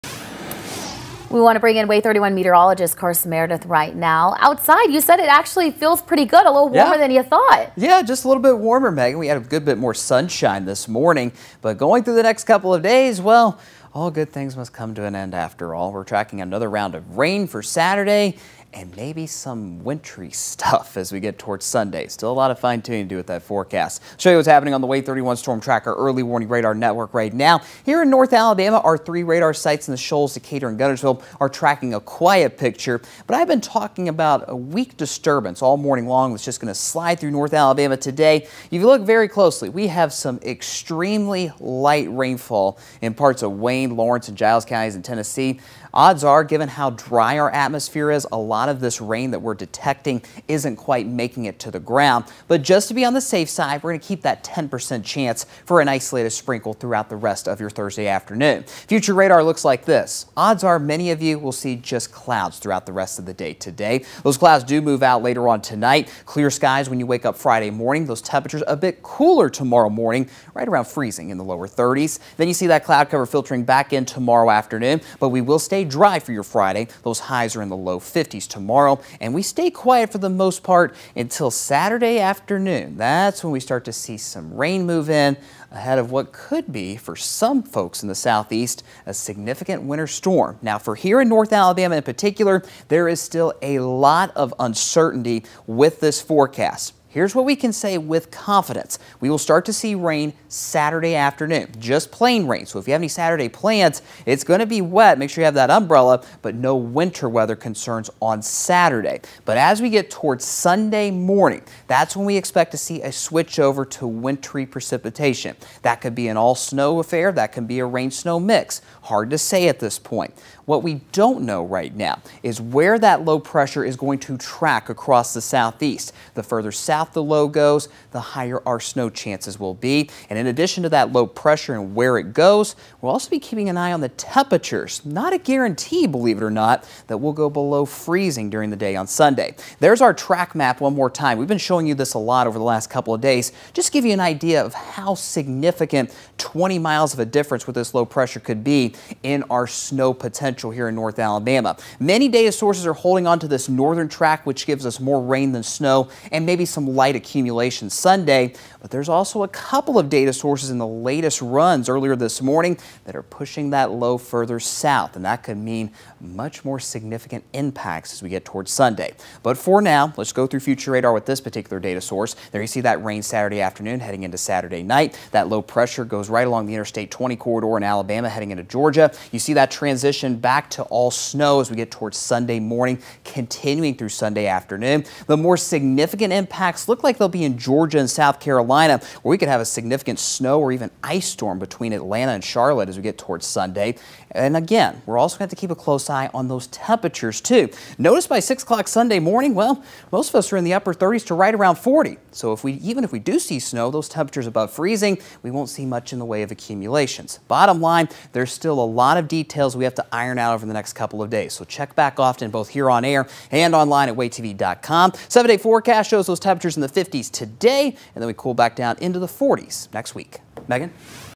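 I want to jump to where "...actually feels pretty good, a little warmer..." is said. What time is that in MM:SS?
00:05.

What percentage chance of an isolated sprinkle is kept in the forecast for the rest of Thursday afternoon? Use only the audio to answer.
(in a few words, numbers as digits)
10%.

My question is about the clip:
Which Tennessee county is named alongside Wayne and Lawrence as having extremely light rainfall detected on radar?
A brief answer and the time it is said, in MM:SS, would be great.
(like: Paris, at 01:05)
Giles, at 00:44.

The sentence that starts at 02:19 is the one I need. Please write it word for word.
There's our track map one more time.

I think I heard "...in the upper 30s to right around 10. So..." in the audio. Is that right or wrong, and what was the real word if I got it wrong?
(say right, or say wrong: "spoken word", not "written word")
wrong: "40", not "10".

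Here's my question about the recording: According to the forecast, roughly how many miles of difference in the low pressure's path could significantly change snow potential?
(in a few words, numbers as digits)
20 miles.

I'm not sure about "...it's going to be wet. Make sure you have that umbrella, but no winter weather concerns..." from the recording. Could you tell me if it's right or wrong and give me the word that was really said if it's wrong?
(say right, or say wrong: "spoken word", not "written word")
right.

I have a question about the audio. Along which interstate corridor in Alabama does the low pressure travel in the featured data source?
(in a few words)
Interstate 20.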